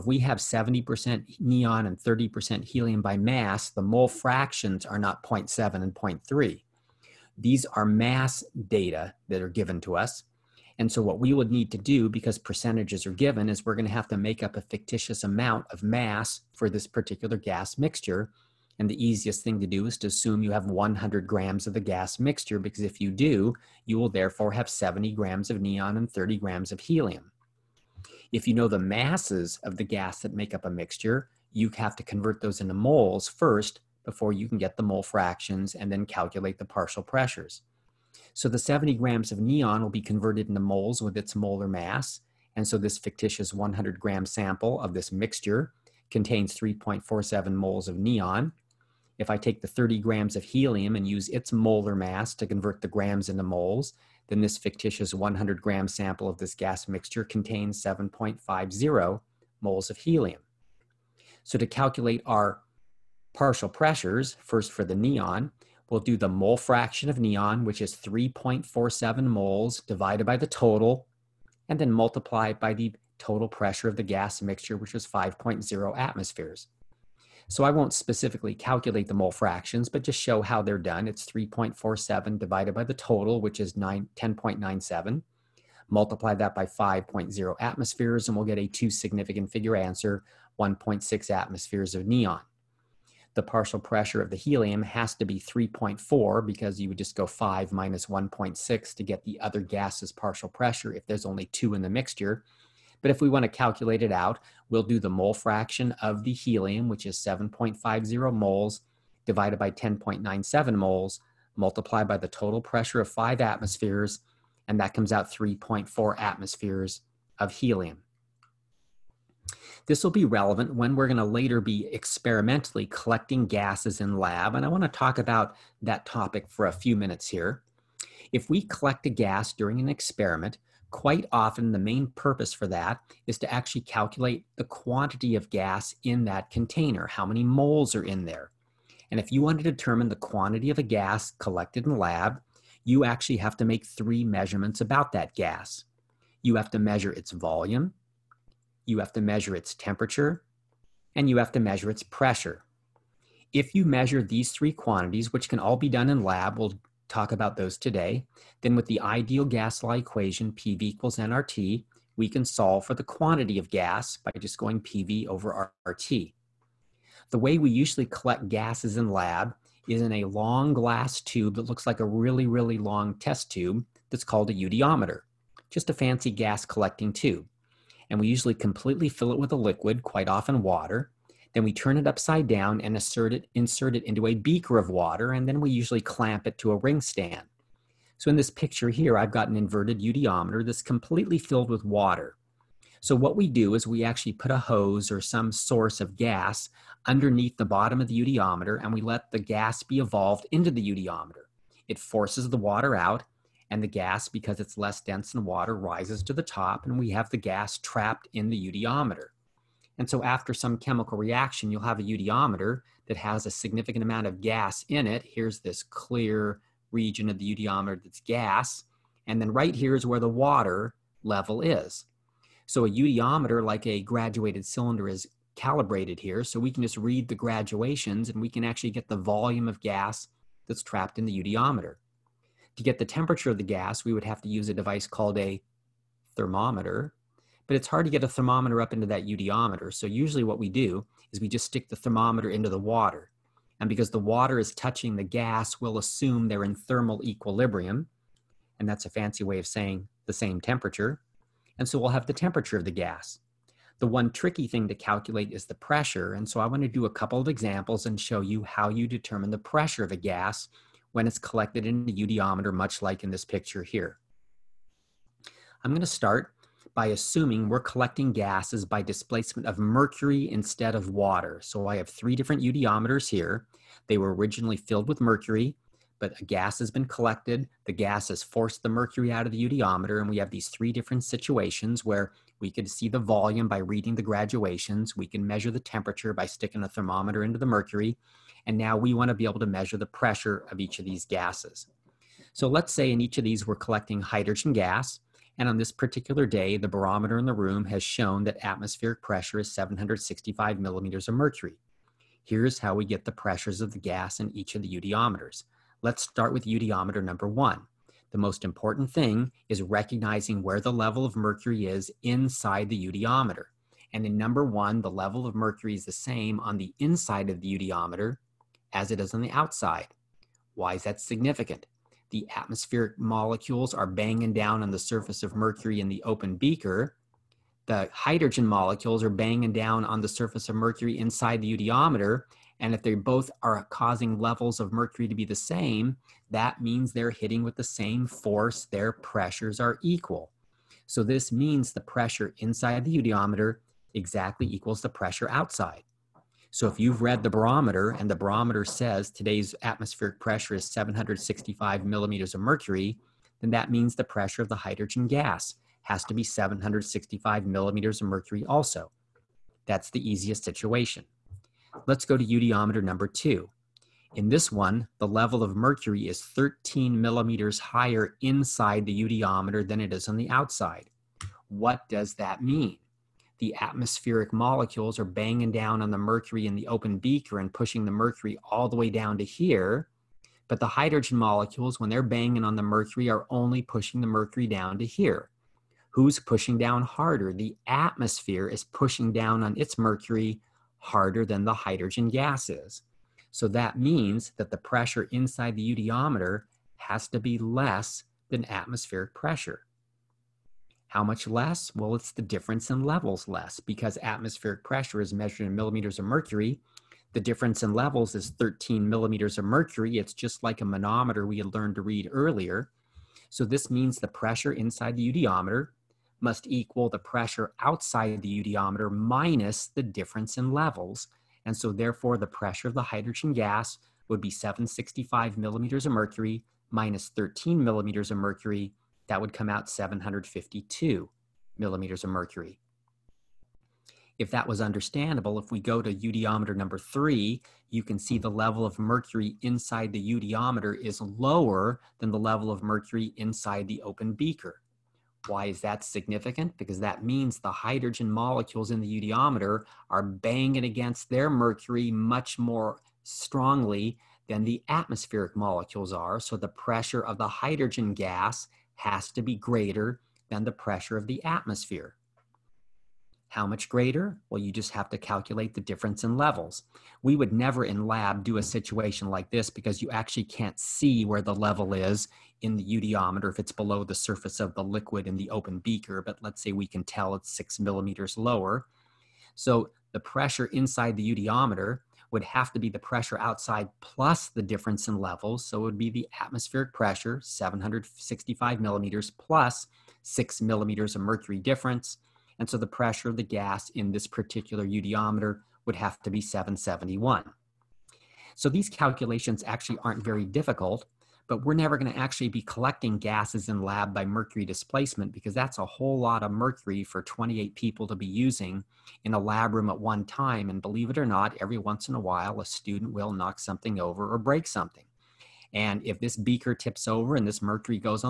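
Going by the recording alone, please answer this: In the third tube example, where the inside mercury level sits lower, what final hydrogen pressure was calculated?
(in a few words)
771.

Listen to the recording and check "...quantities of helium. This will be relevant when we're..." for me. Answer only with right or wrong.
wrong.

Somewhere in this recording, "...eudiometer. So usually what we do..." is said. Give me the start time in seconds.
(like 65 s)
239 s.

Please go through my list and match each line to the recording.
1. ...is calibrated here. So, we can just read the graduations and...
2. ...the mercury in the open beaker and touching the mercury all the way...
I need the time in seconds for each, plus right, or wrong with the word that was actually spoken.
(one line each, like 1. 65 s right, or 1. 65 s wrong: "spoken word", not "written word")
1. 225 s right
2. 376 s wrong: "pushing", not "touching".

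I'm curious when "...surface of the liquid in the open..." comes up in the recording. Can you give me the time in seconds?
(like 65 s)
474 s.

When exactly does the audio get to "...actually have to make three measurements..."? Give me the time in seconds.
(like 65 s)
143 s.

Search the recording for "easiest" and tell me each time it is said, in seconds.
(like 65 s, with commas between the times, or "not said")
19 s, 360 s.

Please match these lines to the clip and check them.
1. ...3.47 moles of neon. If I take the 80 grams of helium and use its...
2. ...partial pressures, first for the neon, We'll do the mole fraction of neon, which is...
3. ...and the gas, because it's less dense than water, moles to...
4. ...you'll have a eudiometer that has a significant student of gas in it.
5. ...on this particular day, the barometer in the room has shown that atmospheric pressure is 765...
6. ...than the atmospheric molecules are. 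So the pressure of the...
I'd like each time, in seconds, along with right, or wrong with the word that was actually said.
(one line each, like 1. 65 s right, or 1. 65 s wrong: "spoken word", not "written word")
1. 46 s wrong: "30", not "80"
2. 63 s right
3. 203 s wrong: "rises", not "moles"
4. 211 s wrong: "amount", not "student"
5. 295 s right
6. 454 s right.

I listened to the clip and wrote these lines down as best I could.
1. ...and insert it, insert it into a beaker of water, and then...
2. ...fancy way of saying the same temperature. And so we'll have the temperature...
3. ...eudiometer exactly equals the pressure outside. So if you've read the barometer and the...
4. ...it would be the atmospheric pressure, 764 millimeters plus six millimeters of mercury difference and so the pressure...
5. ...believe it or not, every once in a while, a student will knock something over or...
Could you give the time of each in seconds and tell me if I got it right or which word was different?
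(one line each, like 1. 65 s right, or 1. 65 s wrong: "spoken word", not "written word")
1. 182 s right
2. 249 s right
3. 343 s right
4. 485 s wrong: "765", not "764"
5. 510 s right.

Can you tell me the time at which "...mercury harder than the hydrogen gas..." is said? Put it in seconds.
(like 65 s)
389 s.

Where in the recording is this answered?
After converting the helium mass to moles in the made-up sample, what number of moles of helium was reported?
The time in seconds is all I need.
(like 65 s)
57 s.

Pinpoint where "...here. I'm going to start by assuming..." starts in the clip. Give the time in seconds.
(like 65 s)
263 s.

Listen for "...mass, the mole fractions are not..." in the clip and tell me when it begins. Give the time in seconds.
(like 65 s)
3 s.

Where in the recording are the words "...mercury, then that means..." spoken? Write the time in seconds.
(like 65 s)
352 s.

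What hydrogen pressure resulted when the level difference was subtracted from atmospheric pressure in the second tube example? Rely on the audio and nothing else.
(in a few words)
752 mmHg.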